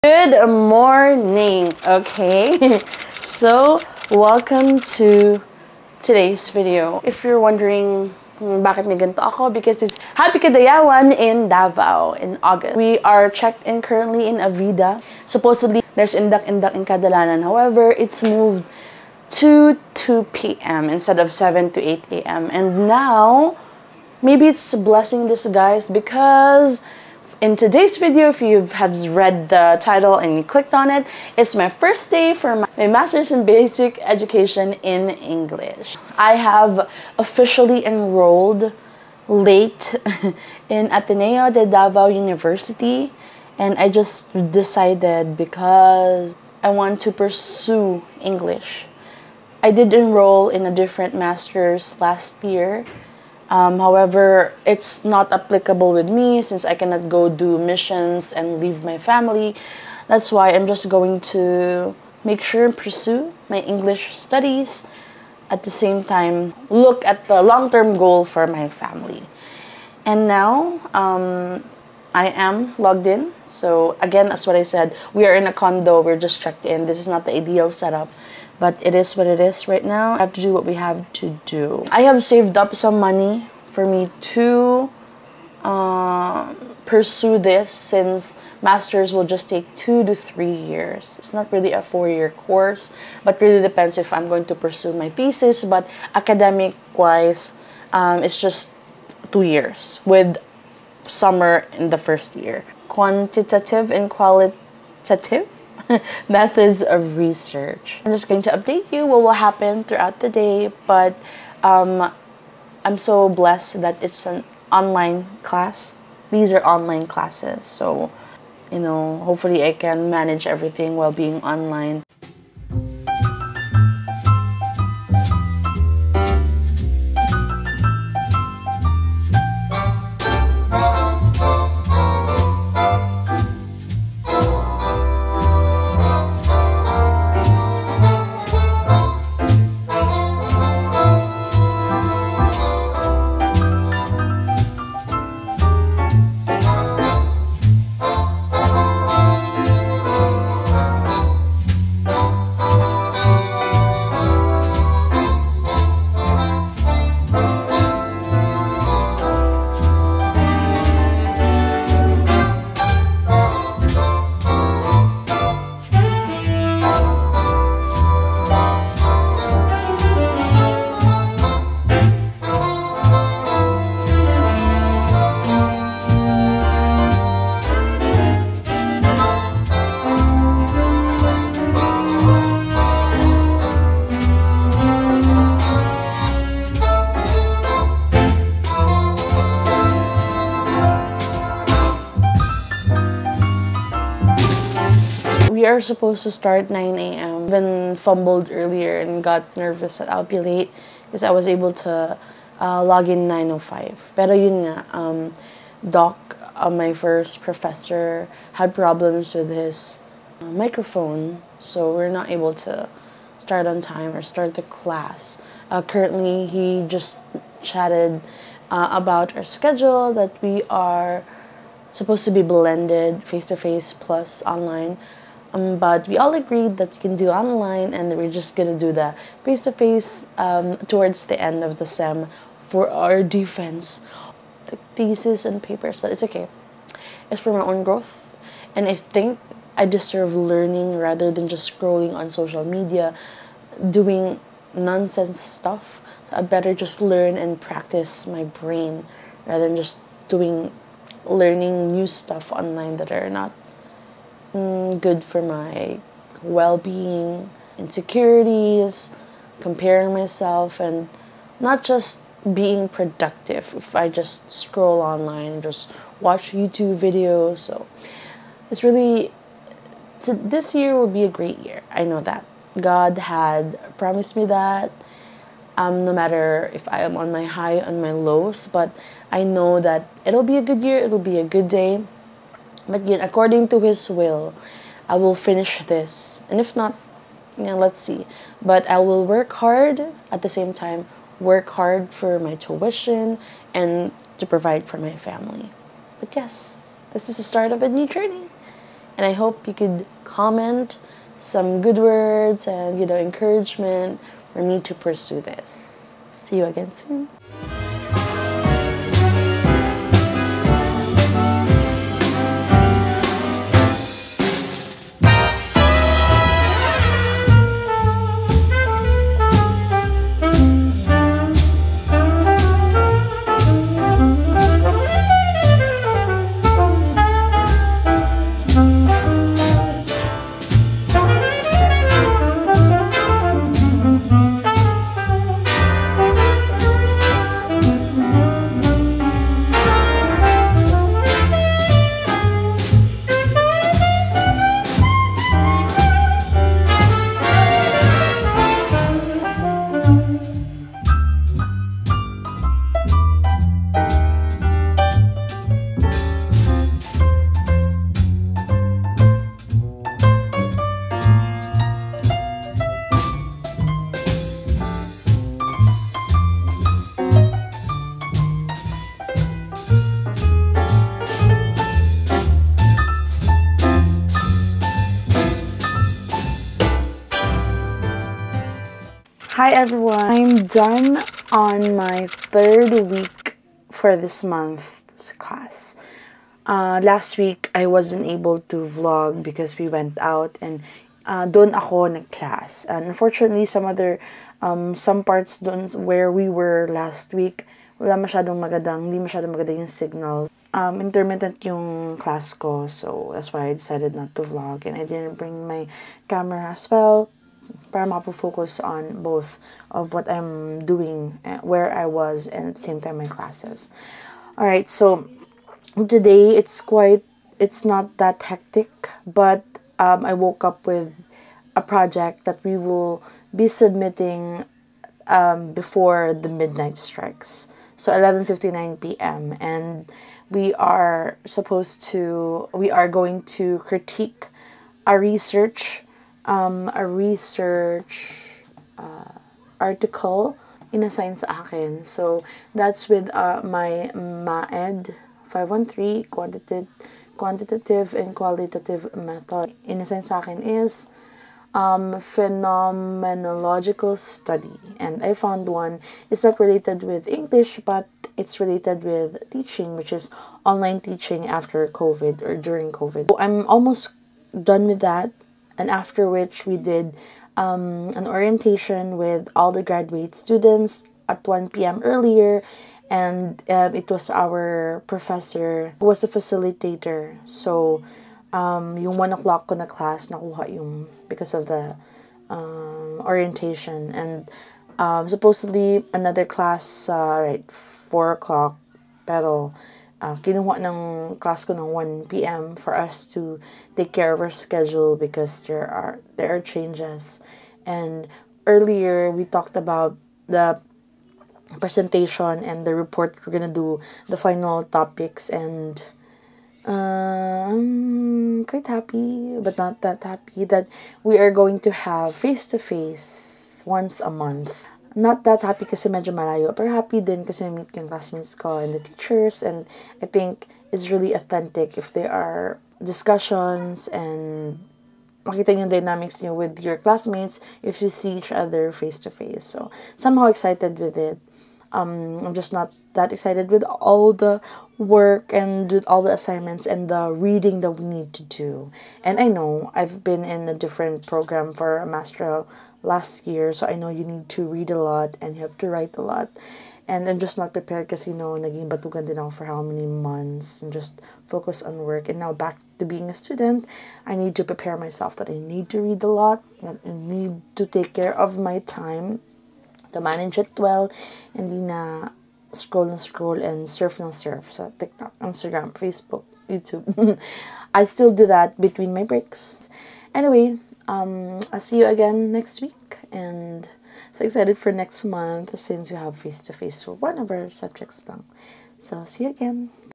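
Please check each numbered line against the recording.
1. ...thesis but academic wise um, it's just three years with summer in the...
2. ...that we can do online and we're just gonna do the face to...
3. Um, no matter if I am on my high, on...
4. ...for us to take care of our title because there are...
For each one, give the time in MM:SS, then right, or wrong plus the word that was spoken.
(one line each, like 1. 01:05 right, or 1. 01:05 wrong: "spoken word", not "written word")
1. 01:35 wrong: "two", not "three"
2. 03:46 right
3. 04:35 right
4. 08:12 wrong: "schedule", not "title".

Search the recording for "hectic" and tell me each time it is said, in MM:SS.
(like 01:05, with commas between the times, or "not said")
06:58.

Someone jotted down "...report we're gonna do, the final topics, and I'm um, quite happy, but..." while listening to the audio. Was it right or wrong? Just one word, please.
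right.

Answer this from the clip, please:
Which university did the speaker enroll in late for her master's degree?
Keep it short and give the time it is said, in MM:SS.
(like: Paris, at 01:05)
Ateneo de Davao University, at 00:40.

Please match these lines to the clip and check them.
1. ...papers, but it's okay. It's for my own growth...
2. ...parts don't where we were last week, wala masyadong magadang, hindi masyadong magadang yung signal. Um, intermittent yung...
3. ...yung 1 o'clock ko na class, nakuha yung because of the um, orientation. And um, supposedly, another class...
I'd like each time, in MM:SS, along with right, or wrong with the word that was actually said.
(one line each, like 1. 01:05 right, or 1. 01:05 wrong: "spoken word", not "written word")
1. 03:55 right
2. 06:35 right
3. 07:59 right.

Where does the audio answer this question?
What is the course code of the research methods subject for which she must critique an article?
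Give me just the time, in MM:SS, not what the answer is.
07:24.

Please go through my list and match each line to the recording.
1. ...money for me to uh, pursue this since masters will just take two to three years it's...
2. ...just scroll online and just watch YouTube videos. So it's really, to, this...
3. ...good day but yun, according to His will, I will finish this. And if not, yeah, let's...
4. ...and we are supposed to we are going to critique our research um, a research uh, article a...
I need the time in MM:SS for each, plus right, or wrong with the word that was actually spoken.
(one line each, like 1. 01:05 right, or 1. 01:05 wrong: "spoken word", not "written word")
1. 01:23 right
2. 04:24 right
3. 04:41 right
4. 07:09 right.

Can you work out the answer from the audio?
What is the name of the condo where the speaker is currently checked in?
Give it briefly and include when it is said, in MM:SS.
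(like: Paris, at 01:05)
Avida, at 00:14.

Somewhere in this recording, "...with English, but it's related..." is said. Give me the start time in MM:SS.
07:37.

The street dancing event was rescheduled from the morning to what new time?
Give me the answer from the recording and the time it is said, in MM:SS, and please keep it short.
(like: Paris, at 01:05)
2 p.m., at 00:19.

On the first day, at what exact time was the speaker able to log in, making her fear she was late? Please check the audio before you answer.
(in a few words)
9:05.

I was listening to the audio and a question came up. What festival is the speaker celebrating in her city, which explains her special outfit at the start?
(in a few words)
Kadayawan.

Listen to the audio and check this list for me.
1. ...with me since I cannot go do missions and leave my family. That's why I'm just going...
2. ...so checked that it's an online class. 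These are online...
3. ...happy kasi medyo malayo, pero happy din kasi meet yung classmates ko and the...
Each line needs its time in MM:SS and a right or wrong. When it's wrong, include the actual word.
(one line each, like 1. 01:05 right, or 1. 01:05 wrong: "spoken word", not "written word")
1. 00:55 right
2. 01:52 wrong: "blessed", not "checked"
3. 08:35 right.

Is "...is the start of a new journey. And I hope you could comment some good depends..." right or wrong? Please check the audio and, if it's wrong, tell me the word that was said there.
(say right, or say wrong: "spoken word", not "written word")
wrong: "words", not "depends".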